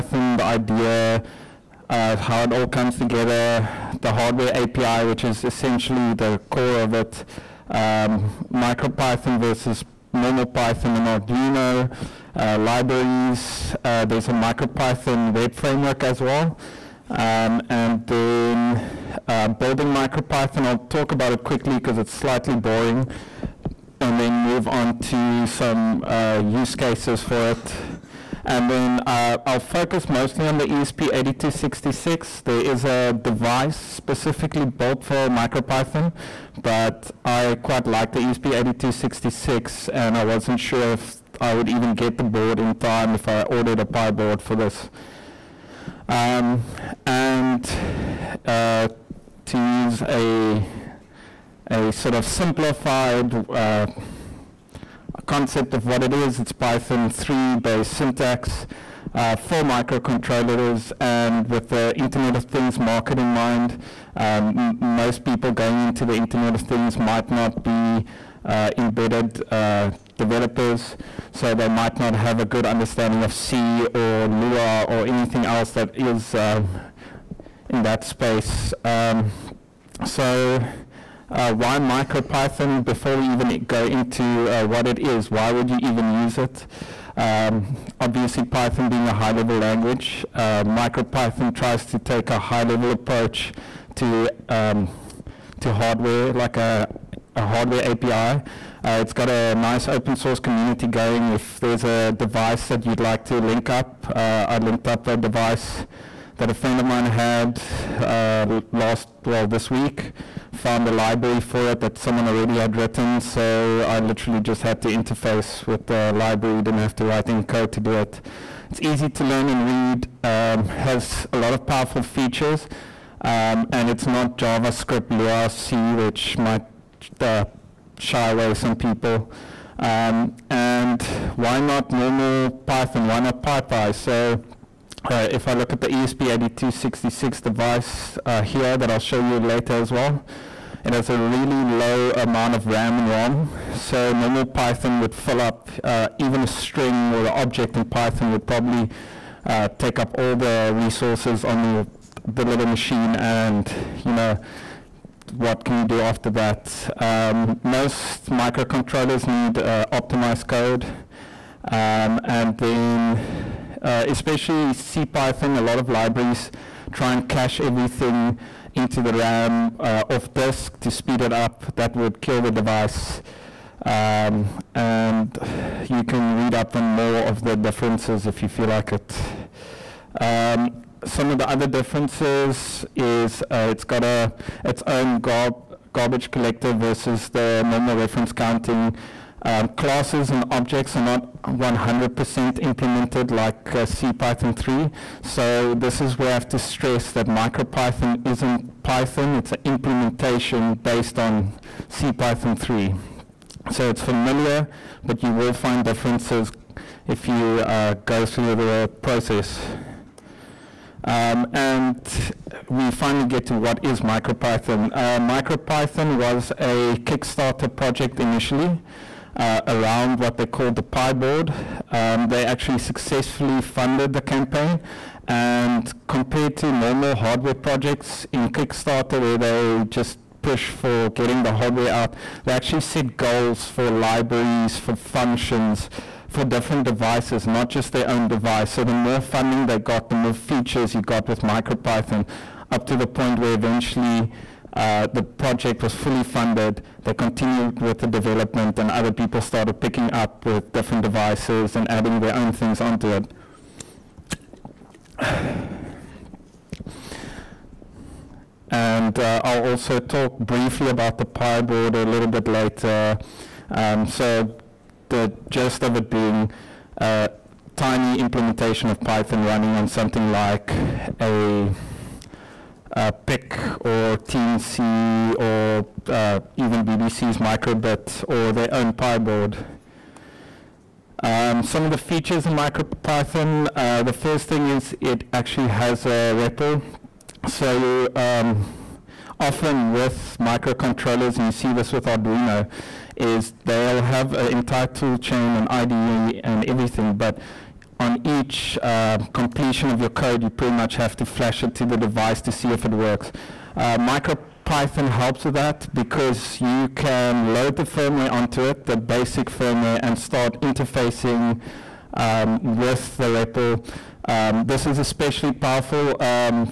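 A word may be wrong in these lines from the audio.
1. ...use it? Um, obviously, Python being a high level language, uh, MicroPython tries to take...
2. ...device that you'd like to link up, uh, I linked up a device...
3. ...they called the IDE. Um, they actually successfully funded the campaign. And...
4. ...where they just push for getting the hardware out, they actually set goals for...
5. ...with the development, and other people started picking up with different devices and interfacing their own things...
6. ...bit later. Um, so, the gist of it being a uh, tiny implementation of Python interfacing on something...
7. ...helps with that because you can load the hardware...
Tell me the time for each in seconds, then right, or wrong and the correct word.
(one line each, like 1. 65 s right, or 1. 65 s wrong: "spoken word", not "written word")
1. 86 s right
2. 102 s right
3. 220 s wrong: "PyBoard", not "IDE"
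4. 229 s right
5. 247 s wrong: "adding", not "interfacing"
6. 262 s wrong: "running", not "interfacing"
7. 305 s wrong: "firmware", not "hardware".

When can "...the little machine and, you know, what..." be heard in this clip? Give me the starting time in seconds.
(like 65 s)
152 s.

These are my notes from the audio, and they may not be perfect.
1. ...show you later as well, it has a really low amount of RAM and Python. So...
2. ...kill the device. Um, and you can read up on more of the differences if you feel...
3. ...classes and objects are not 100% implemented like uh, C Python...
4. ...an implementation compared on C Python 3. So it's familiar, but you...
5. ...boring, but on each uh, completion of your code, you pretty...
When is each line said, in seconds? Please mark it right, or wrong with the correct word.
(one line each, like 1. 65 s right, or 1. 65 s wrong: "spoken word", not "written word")
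1. 138 s wrong: "ROM", not "Python"
2. 172 s right
3. 189 s right
4. 199 s wrong: "based", not "compared"
5. 296 s wrong: "everything", not "boring".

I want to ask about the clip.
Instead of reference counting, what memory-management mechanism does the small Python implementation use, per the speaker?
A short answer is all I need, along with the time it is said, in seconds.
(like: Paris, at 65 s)
garbage collector, at 185 s.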